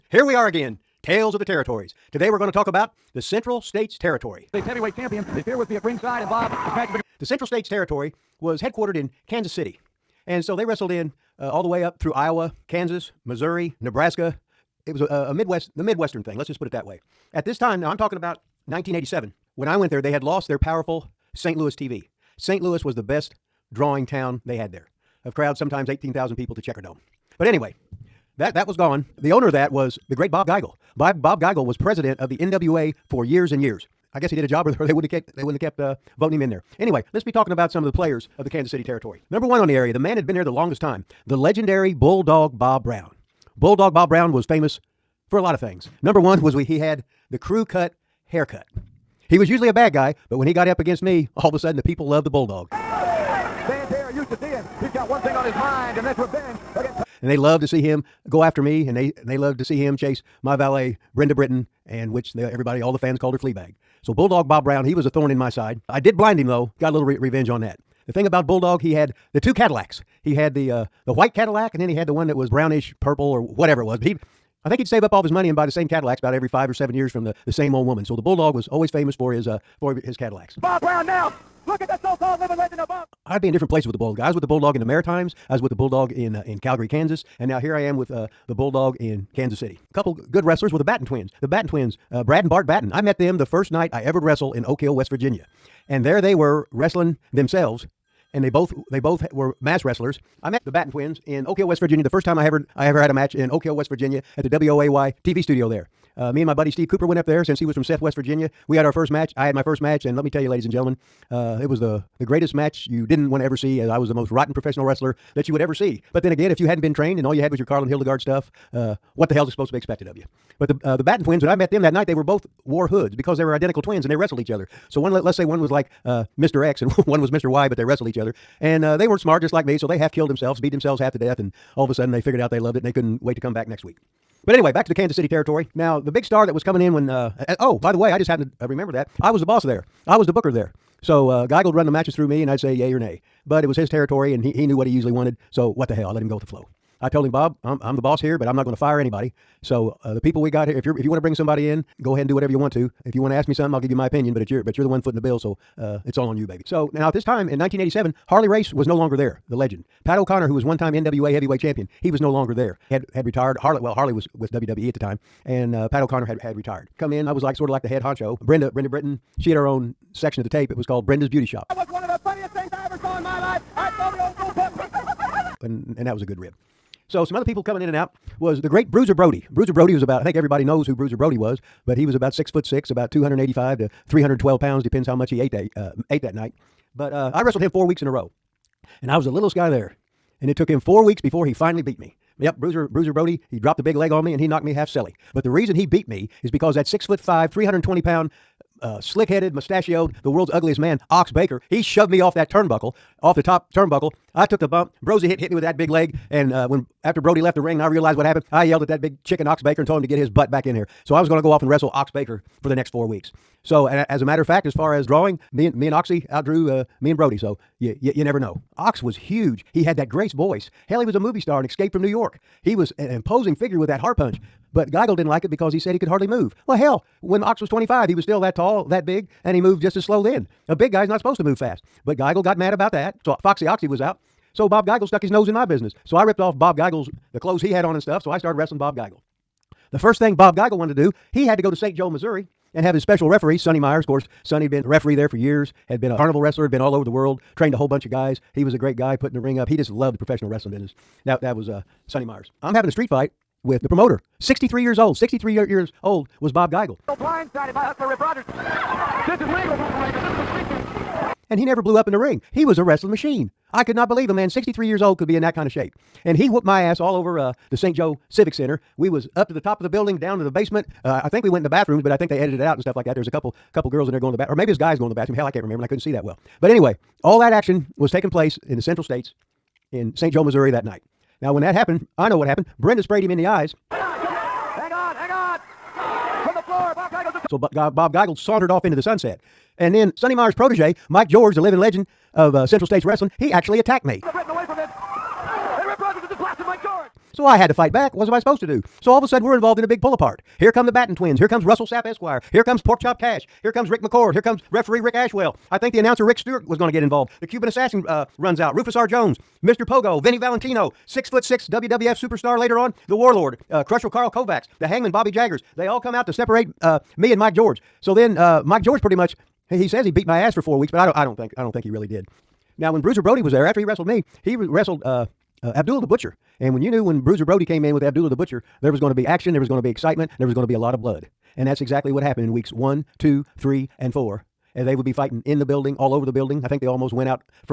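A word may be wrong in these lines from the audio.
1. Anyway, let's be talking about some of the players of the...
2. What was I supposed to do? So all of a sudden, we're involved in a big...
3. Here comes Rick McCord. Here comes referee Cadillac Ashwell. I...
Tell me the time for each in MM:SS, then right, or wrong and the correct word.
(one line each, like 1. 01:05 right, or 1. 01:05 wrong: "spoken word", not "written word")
1. 00:36 right
2. 04:58 right
3. 05:03 wrong: "Rick", not "Cadillac".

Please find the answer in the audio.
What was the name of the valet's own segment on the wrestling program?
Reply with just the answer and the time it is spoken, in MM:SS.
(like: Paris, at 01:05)
Brenda's Beauty Shop, at 02:51.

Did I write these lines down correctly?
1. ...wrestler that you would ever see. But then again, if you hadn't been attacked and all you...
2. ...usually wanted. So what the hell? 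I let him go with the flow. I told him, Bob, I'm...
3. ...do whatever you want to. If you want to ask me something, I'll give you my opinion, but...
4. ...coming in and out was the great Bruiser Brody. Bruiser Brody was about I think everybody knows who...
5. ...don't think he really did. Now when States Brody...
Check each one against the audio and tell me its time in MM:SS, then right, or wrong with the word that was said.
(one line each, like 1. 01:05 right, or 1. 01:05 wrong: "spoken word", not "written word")
1. 01:54 wrong: "trained", not "attacked"
2. 02:24 right
3. 02:32 right
4. 02:57 right
5. 05:21 wrong: "Bruiser", not "States".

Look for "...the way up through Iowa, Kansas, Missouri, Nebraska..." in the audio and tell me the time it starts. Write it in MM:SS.
00:11.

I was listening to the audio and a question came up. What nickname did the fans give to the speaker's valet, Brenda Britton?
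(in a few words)
Fleabag.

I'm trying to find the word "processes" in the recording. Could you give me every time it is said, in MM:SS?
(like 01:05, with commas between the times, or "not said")
not said.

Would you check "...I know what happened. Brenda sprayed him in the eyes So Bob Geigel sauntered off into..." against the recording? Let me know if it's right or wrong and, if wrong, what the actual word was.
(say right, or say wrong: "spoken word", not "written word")
right.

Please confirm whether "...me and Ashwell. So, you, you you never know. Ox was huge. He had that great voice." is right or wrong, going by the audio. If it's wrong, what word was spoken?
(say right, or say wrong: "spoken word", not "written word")
wrong: "Brody", not "Ashwell".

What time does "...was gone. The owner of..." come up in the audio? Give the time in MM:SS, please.
00:28.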